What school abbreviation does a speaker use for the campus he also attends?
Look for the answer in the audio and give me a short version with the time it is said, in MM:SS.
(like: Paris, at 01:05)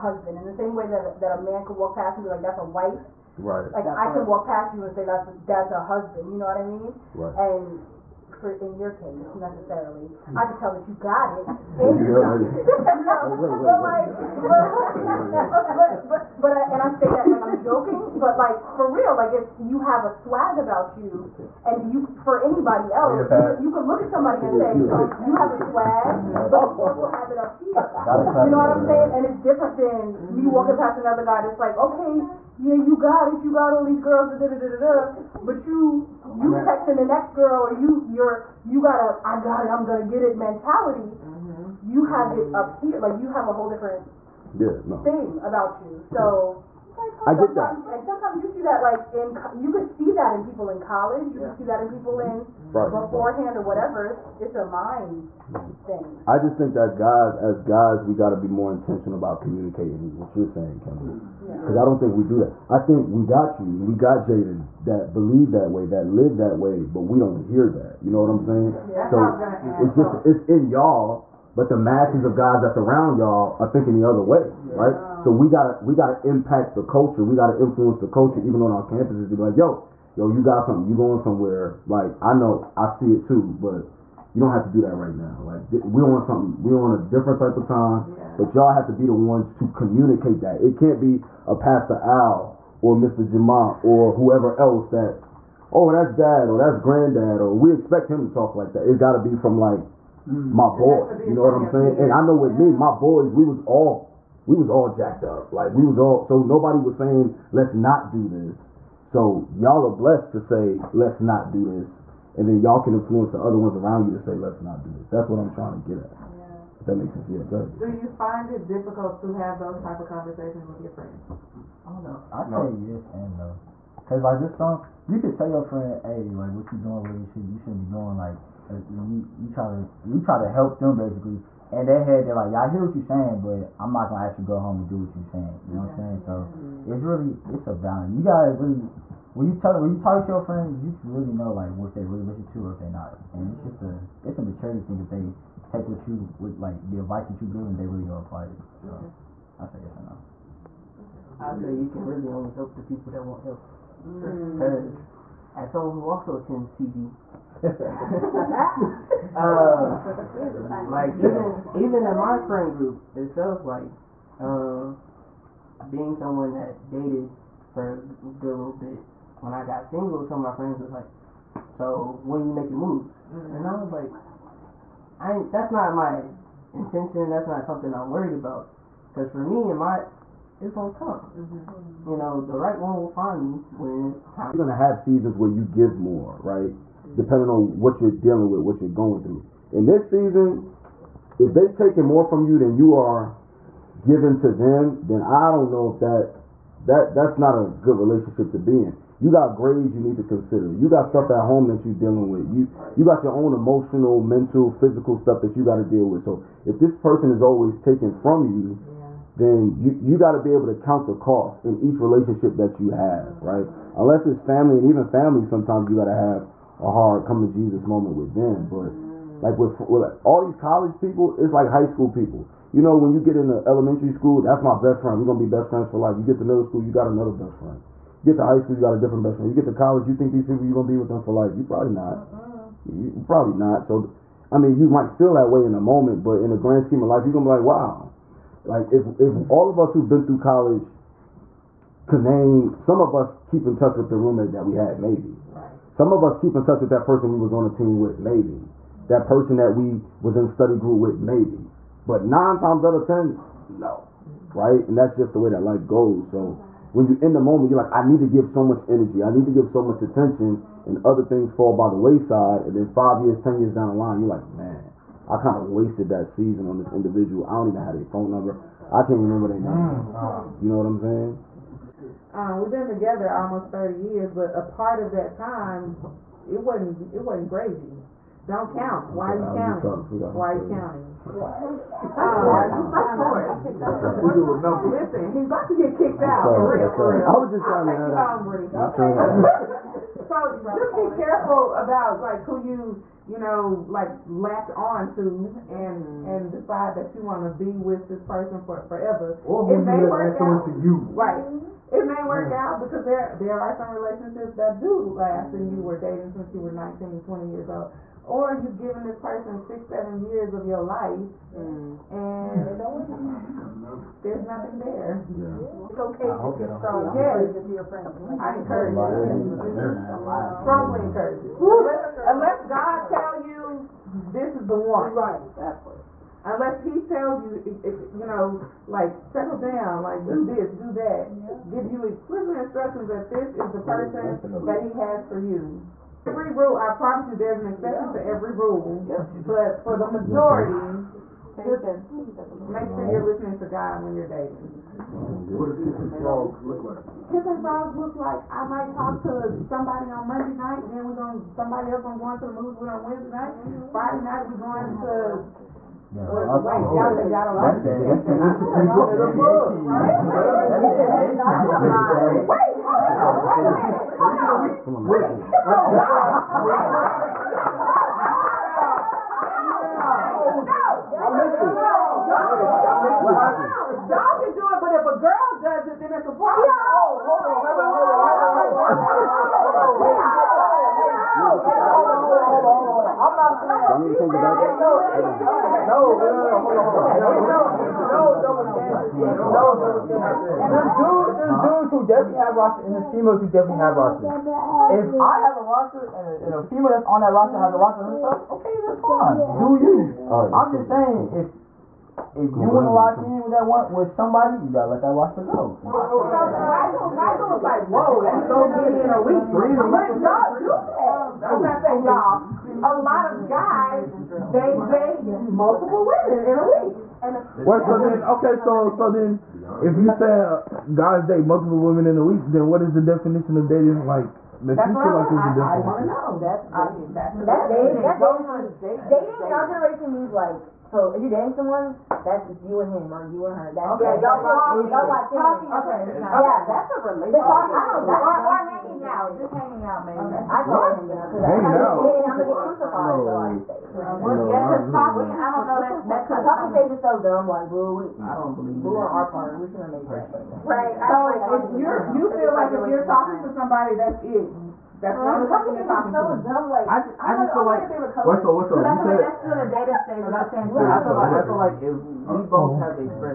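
PV, at 02:36.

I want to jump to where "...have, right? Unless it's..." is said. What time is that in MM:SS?
03:32.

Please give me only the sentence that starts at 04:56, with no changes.
and decide that you want to be with this person for forever.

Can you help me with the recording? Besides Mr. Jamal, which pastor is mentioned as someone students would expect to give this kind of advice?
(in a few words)
Pastor Al.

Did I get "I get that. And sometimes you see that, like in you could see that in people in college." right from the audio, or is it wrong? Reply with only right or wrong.
right.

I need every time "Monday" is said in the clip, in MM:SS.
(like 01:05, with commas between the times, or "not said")
05:50.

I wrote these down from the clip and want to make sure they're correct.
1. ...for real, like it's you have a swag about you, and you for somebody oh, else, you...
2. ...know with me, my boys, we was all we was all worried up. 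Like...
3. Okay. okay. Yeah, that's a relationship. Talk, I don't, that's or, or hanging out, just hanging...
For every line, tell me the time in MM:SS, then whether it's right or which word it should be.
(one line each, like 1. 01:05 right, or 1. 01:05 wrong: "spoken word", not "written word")
1. 00:18 wrong: "anybody", not "somebody"
2. 01:42 wrong: "jacked", not "worried"
3. 07:15 right.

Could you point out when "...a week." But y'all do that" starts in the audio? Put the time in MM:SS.
06:49.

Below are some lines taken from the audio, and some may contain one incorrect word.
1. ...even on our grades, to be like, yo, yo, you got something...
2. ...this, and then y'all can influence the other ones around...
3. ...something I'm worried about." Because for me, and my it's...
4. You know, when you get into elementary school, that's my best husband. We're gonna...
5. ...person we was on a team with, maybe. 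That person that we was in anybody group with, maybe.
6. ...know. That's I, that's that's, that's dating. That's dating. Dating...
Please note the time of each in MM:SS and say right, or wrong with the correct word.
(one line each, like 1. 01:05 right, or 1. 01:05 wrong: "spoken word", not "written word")
1. 01:18 wrong: "campuses", not "grades"
2. 01:51 right
3. 02:57 right
4. 03:42 wrong: "friend", not "husband"
5. 04:07 wrong: "study", not "anybody"
6. 07:06 right.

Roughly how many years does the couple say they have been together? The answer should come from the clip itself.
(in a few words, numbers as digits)
almost 30 years.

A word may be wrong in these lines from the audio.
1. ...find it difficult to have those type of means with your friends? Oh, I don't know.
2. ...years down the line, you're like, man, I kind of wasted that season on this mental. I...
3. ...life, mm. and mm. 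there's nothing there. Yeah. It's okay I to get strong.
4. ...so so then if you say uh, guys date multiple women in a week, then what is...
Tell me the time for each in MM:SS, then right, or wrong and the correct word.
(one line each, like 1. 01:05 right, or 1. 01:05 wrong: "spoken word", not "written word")
1. 01:58 wrong: "conversations", not "means"
2. 04:23 wrong: "individual", not "mental"
3. 05:10 right
4. 06:58 right.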